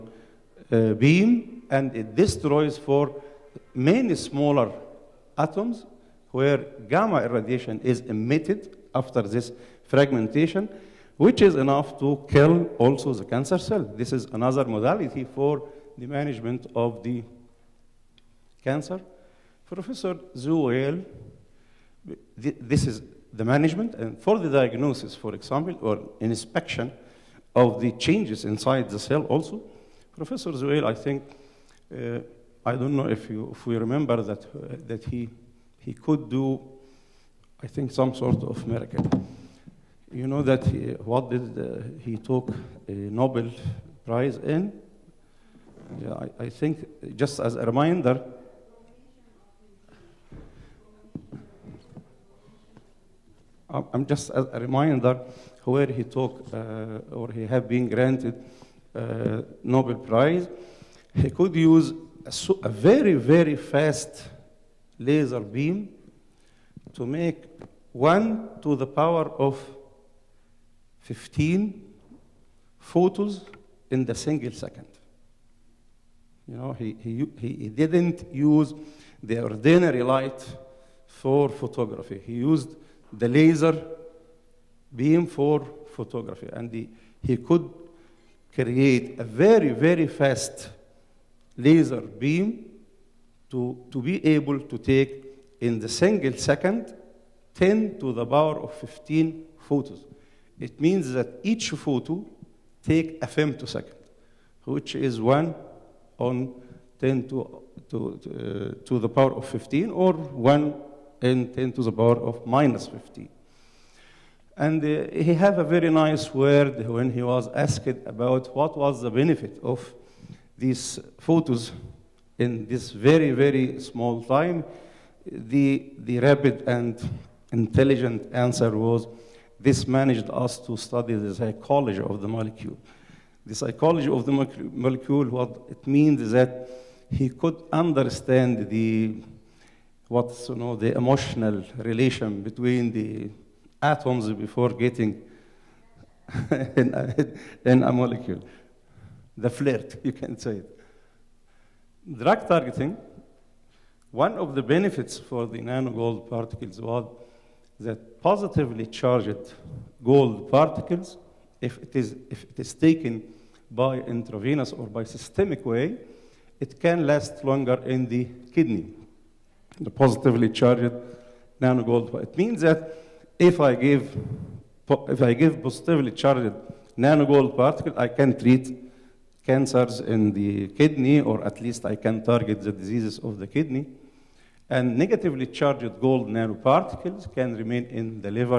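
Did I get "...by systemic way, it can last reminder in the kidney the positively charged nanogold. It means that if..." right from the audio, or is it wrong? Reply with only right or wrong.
wrong.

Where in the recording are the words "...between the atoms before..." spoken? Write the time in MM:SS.
02:22.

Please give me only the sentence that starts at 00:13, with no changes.
This is another modality for the management of the cancer.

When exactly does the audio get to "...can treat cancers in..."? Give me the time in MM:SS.
02:58.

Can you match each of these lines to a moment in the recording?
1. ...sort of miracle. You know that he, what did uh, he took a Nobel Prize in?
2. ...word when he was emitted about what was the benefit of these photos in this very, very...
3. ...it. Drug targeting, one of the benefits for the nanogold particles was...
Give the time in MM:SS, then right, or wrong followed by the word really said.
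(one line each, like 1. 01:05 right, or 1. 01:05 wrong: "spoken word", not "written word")
1. 00:38 right
2. 01:56 wrong: "asked", not "emitted"
3. 02:30 right.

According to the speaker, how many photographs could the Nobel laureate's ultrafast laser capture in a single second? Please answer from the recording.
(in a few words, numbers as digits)
10^15.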